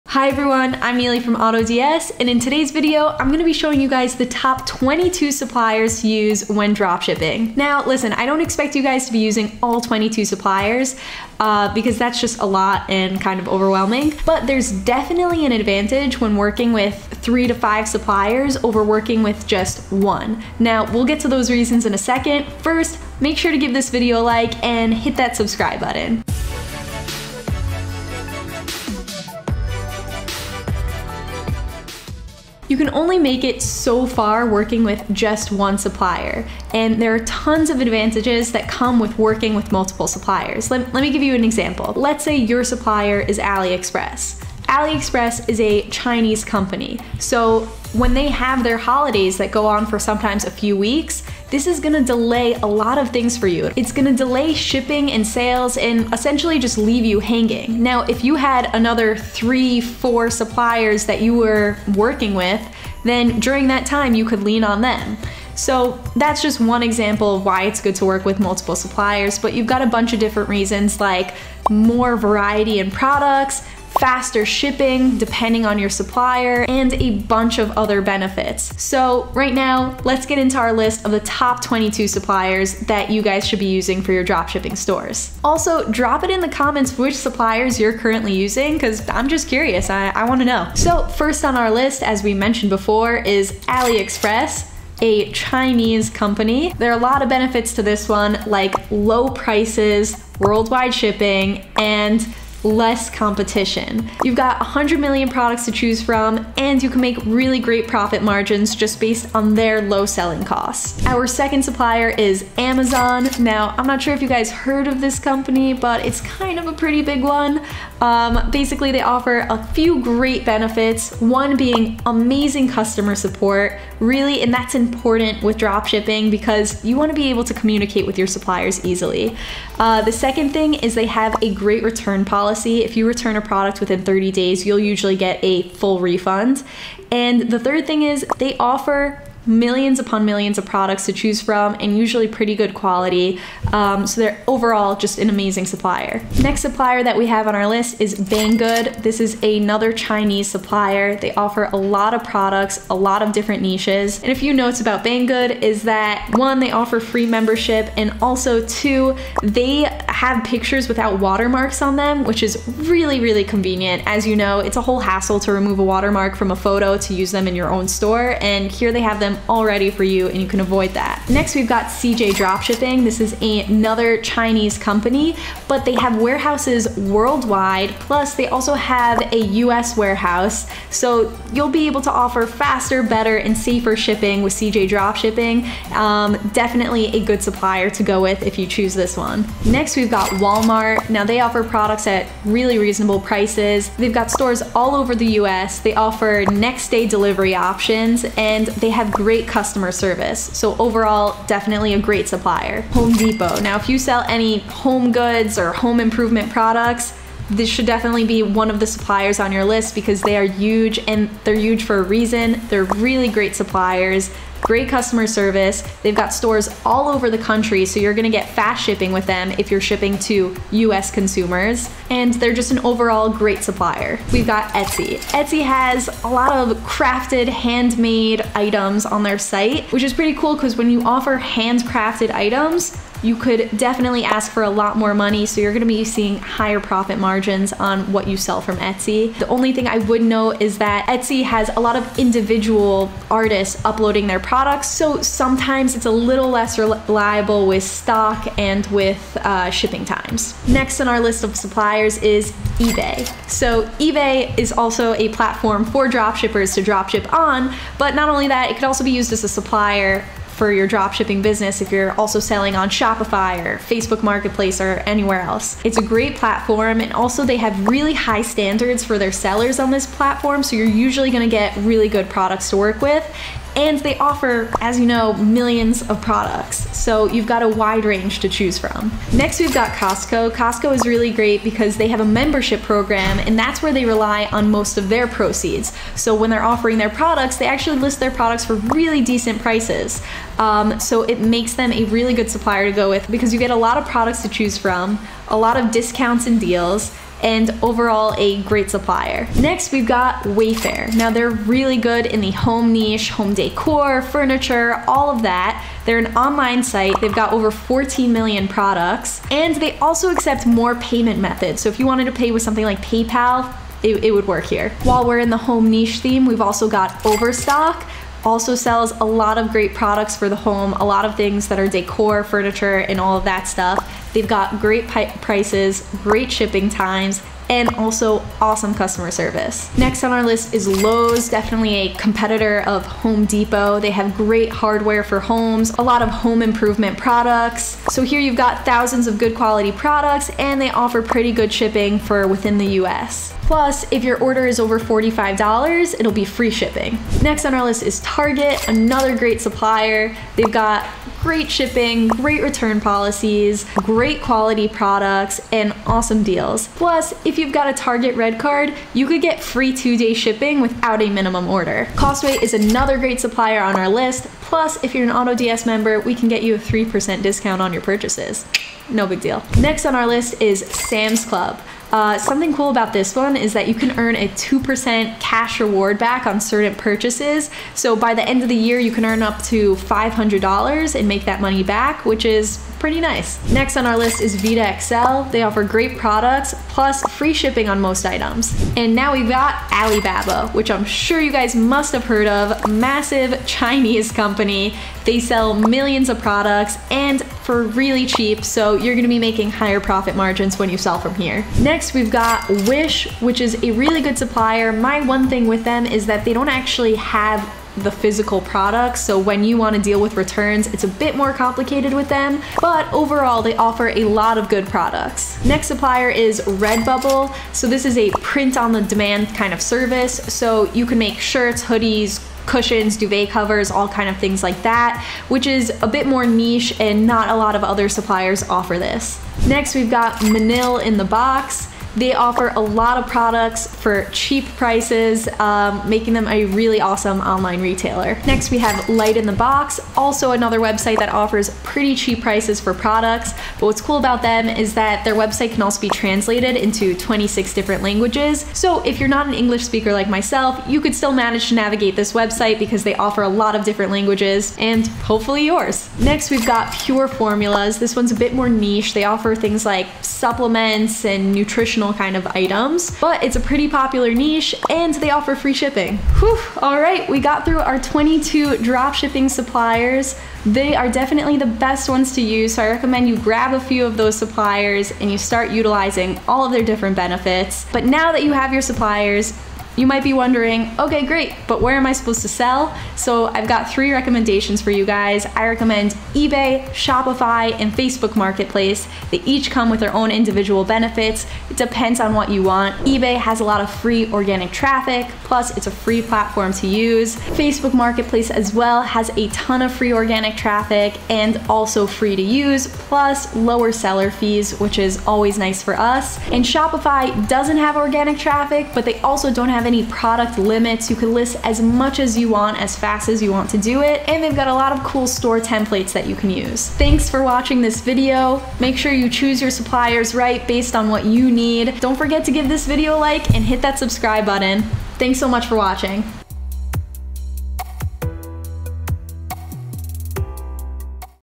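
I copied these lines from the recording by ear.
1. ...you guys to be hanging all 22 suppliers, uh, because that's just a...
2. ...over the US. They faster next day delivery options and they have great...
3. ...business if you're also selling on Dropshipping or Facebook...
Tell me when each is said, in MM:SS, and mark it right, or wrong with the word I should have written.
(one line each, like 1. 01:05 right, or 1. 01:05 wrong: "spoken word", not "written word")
1. 00:08 wrong: "using", not "hanging"
2. 03:14 wrong: "offer", not "faster"
3. 04:21 wrong: "Shopify", not "Dropshipping".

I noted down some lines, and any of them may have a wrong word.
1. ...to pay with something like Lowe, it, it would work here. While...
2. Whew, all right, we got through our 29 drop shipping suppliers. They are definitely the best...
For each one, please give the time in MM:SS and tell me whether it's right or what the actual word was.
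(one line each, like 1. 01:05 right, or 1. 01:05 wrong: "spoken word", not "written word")
1. 05:12 wrong: "PayPal", not "Lowe"
2. 07:46 wrong: "22", not "29".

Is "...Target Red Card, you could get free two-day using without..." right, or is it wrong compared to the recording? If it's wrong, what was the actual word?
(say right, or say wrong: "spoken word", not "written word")
wrong: "shipping", not "using".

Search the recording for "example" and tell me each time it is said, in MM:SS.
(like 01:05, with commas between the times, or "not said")
00:41, 01:06.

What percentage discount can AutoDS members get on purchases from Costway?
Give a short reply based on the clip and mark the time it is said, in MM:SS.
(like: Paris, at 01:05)
3%, at 06:06.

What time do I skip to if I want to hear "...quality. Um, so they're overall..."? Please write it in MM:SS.
02:22.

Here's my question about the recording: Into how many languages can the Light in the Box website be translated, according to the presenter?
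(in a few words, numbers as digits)
26.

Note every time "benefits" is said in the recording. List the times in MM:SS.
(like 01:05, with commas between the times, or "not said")
01:18, 01:37, 02:00, 07:57, 08:10.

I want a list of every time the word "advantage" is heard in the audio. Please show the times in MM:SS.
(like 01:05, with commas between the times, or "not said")
00:15, 00:37.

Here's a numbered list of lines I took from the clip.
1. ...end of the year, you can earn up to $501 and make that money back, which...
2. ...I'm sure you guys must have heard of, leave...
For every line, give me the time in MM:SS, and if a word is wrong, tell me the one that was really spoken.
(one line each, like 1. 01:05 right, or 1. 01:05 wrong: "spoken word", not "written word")
1. 06:18 wrong: "500", not "501"
2. 06:30 wrong: "massive", not "leave".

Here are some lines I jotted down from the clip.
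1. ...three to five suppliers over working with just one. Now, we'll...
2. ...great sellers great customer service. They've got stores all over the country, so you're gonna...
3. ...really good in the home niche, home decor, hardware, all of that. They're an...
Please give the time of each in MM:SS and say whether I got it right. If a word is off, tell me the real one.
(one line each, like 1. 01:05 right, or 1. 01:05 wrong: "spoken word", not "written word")
1. 00:17 right
2. 03:33 wrong: "suppliers", not "sellers"
3. 05:01 wrong: "furniture", not "hardware".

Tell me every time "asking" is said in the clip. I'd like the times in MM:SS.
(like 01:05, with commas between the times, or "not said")
not said.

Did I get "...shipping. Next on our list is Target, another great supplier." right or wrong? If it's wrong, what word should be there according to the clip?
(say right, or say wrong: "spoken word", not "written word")
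right.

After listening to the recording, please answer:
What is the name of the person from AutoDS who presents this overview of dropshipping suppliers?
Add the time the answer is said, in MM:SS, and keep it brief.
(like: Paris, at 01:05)
Ely, at 00:00.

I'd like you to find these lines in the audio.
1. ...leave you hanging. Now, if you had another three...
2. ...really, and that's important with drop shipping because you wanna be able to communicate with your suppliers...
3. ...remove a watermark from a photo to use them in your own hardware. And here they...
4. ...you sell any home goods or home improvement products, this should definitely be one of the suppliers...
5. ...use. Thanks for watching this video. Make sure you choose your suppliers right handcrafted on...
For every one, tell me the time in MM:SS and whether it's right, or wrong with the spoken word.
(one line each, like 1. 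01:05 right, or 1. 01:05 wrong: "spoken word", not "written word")
1. 00:56 right
2. 02:04 right
3. 02:45 wrong: "store", not "hardware"
4. 03:23 right
5. 08:36 wrong: "based", not "handcrafted".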